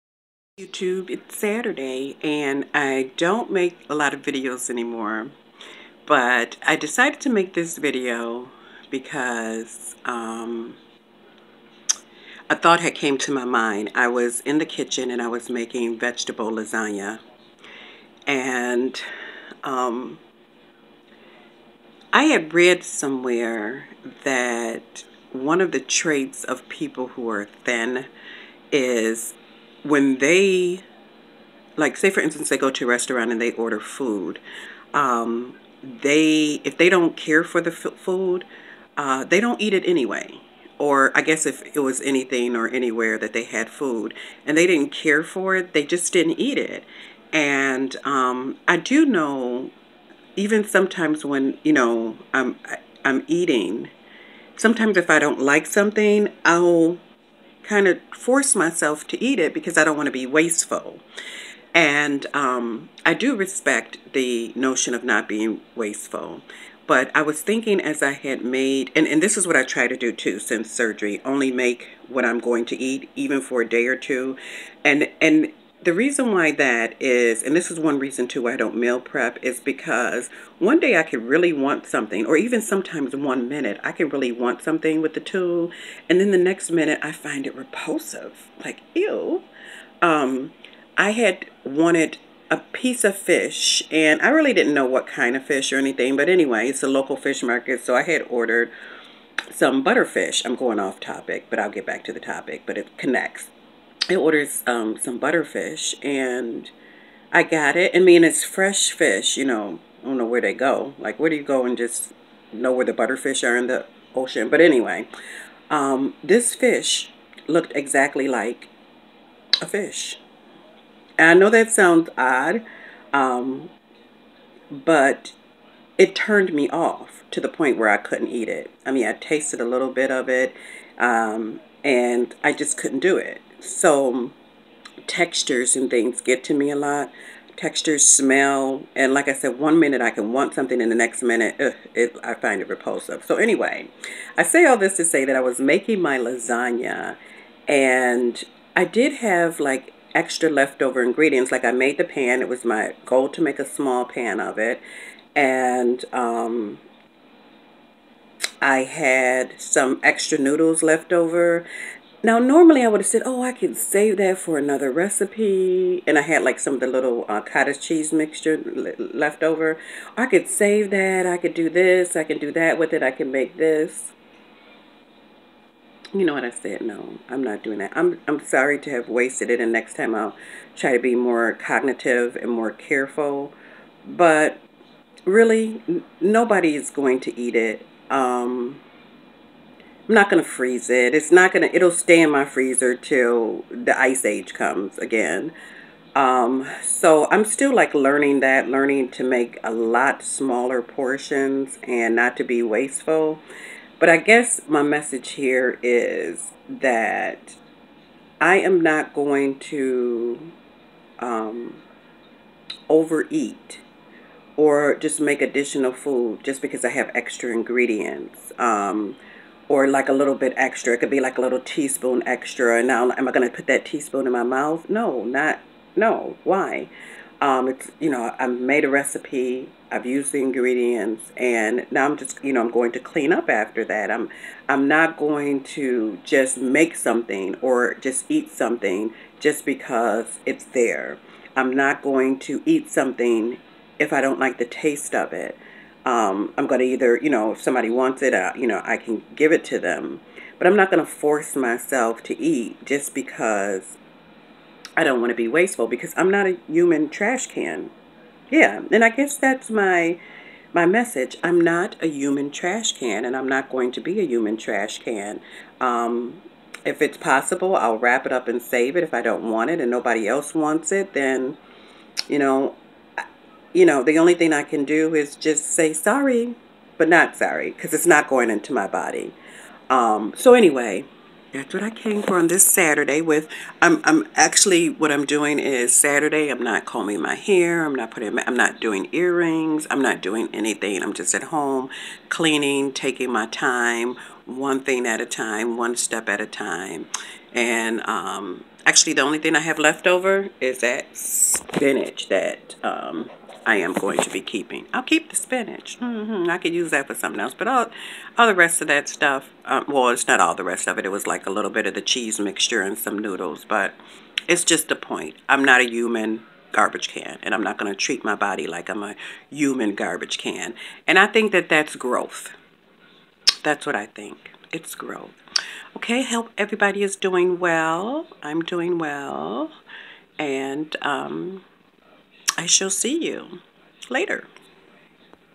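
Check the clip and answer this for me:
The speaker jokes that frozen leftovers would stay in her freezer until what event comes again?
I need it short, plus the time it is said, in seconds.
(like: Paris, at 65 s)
the ice age, at 193 s.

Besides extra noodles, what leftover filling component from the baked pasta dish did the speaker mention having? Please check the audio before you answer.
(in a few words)
cottage cheese mixture.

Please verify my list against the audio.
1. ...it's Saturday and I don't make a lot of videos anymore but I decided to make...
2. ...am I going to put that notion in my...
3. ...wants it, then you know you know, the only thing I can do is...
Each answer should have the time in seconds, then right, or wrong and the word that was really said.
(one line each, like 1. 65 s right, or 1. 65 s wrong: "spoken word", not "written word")
1. 1 s right
2. 223 s wrong: "teaspoon", not "notion"
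3. 270 s right.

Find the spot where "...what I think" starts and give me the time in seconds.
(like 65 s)
323 s.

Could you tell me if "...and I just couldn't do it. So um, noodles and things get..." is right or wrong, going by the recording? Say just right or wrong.
wrong.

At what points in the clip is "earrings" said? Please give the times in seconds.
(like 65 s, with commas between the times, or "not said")
289 s.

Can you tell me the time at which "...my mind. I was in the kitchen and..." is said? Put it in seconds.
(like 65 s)
13 s.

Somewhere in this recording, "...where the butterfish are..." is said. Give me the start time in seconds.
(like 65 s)
112 s.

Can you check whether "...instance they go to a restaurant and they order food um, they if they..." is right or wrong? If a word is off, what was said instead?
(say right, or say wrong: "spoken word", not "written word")
right.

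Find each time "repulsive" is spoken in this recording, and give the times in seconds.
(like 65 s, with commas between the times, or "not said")
87 s, 142 s.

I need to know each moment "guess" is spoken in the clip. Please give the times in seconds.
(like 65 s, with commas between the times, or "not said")
41 s, 204 s, 259 s.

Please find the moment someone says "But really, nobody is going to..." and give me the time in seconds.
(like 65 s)
184 s.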